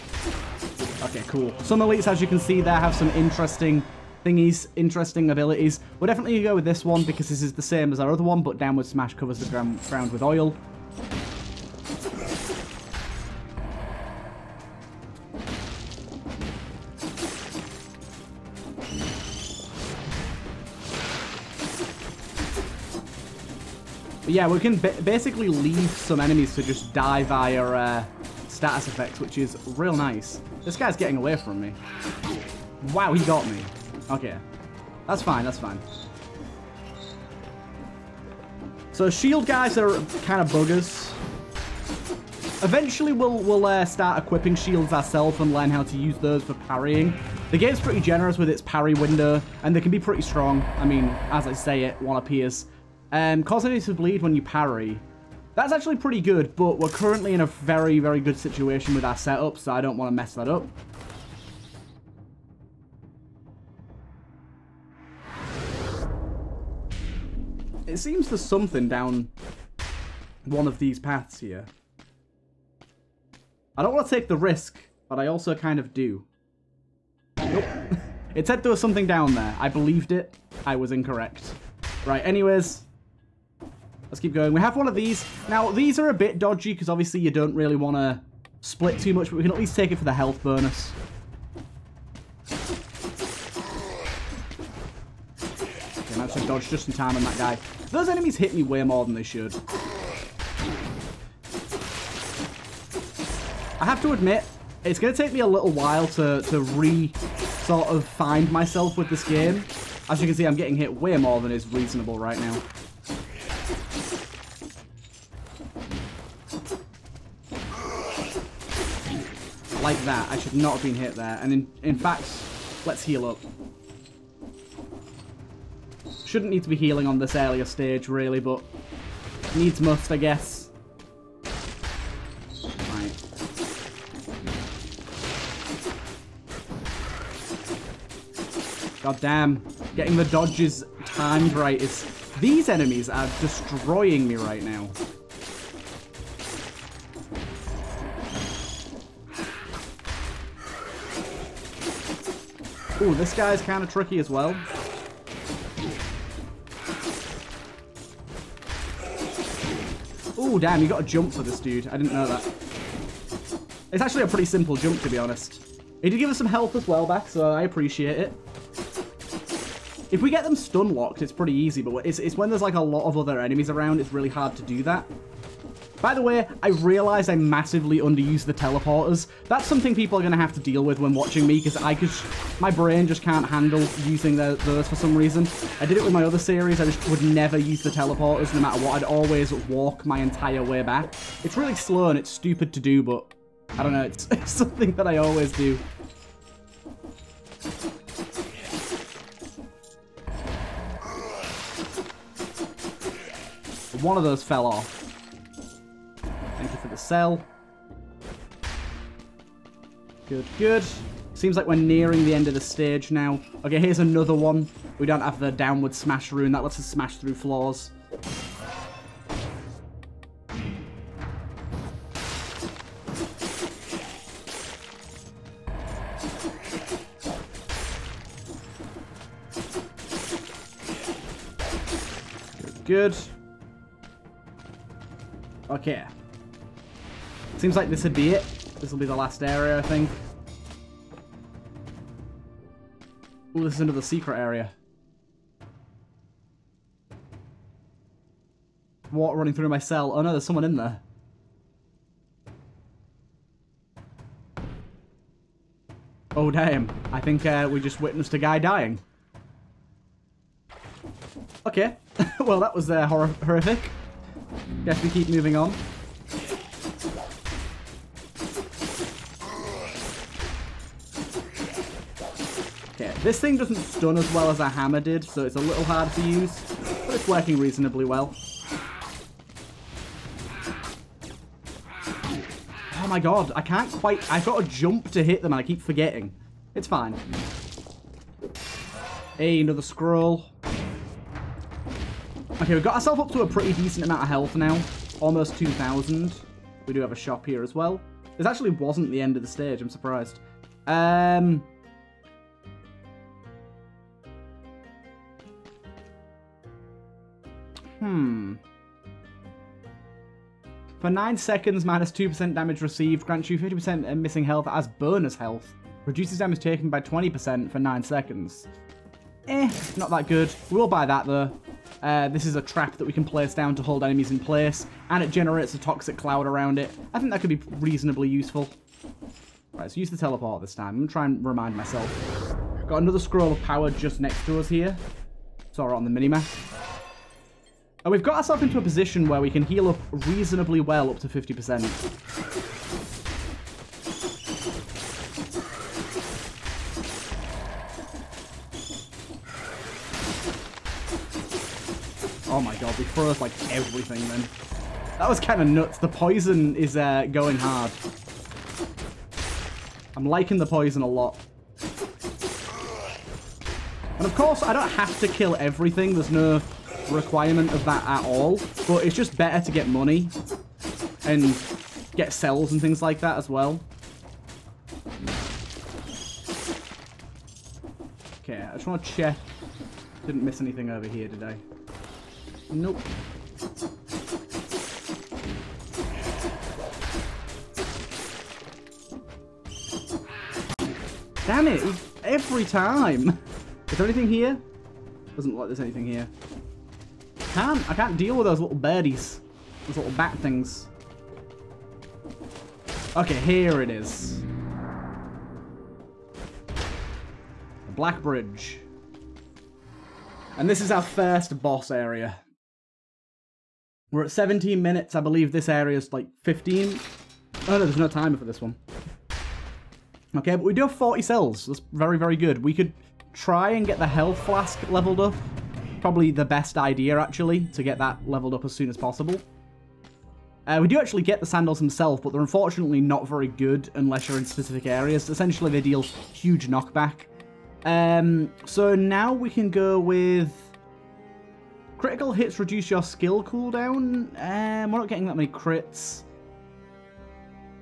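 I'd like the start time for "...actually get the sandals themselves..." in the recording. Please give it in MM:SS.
07:10.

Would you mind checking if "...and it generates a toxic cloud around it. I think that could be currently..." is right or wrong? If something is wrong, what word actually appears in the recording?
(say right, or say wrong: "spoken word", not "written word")
wrong: "reasonably", not "currently".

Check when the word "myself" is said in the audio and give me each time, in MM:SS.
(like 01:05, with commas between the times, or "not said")
01:48, 05:31.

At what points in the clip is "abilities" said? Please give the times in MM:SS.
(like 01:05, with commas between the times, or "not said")
00:05.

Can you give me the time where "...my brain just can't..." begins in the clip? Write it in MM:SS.
03:02.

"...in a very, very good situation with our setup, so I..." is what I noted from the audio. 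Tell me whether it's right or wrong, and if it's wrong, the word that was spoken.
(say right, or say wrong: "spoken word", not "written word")
right.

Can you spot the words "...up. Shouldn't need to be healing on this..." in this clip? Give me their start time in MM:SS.
02:03.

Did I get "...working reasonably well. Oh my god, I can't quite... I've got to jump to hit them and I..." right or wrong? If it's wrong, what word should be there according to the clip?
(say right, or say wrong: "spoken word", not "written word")
right.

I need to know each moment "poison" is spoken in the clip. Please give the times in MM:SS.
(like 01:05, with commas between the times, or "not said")
05:56, 06:00.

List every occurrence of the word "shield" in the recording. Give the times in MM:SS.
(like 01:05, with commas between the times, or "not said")
00:39, 00:44.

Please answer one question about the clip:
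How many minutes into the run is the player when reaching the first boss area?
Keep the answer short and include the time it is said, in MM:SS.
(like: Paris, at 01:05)
17 minutes, at 06:54.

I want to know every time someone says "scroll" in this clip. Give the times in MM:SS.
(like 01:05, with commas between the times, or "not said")
04:49, 05:33.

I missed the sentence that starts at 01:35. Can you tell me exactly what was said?
Okay, managed to dodge just in time on that guy.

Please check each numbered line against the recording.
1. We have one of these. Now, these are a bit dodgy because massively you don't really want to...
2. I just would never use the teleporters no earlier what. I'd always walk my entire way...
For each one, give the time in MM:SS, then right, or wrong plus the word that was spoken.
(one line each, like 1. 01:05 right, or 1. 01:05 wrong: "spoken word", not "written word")
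1. 01:24 wrong: "obviously", not "massively"
2. 03:06 wrong: "matter", not "earlier".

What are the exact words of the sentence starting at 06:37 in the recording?
I can't deal with those little birdies.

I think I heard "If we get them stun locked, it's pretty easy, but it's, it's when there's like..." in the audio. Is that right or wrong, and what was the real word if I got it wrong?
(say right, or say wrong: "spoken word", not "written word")
right.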